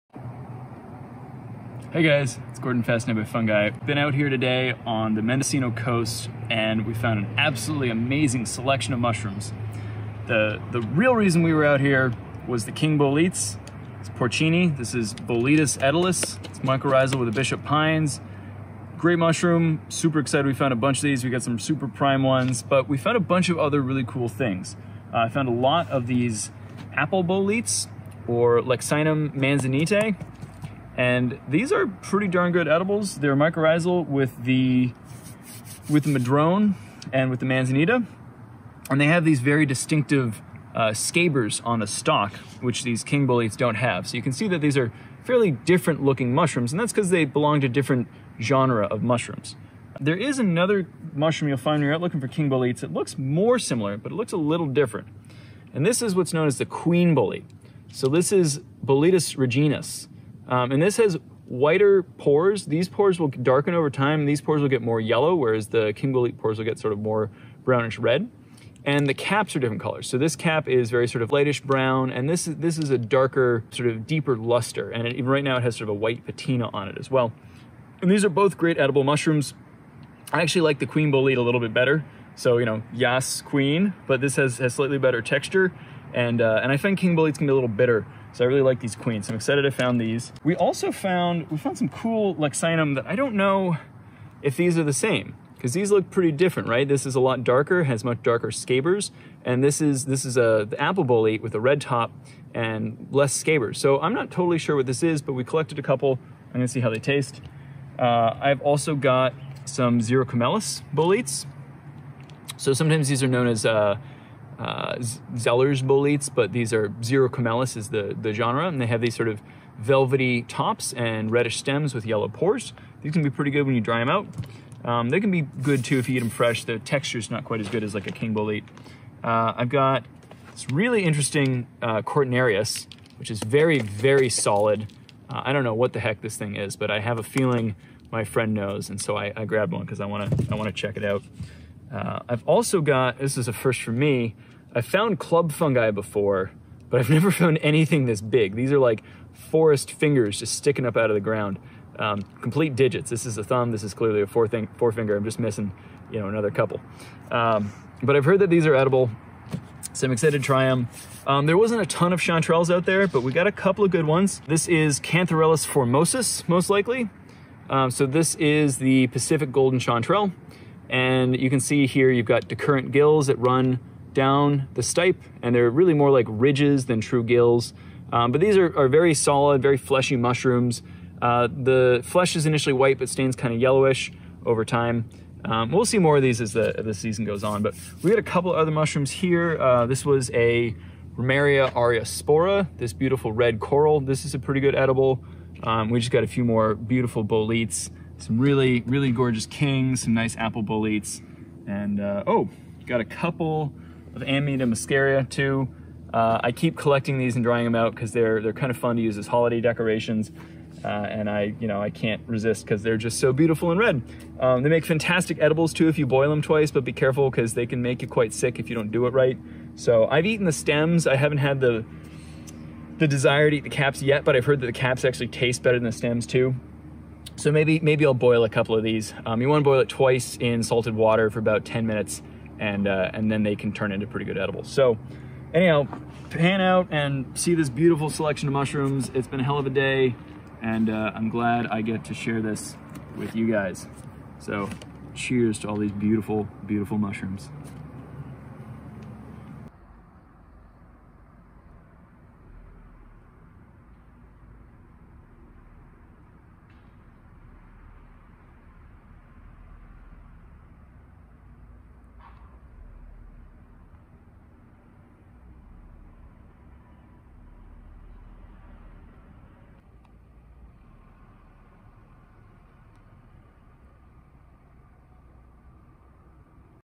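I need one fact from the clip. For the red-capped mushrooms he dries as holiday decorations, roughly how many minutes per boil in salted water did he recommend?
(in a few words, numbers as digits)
10 minutes.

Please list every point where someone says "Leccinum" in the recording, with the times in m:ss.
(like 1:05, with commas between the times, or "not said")
0:28, 1:32.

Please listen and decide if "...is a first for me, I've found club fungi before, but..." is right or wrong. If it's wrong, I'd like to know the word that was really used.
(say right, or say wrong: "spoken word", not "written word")
right.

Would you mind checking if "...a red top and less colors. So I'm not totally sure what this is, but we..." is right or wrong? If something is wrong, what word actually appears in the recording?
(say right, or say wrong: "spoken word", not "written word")
wrong: "scabers", not "colors".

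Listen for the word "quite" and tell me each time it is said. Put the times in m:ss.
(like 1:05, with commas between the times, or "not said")
2:07, 3:38.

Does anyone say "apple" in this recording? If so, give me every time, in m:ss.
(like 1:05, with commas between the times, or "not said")
0:26, 1:40, 3:20.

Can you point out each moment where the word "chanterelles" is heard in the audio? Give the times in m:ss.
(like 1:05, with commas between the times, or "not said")
2:42, 2:49.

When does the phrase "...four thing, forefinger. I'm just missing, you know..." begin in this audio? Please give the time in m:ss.
2:34.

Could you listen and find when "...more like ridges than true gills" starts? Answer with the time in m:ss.
2:55.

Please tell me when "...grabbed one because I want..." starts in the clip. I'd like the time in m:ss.
2:19.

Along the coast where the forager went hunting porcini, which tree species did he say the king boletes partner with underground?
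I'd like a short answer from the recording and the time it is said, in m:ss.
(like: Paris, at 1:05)
bishop pines, at 0:17.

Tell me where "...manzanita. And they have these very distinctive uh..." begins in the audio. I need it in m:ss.
0:37.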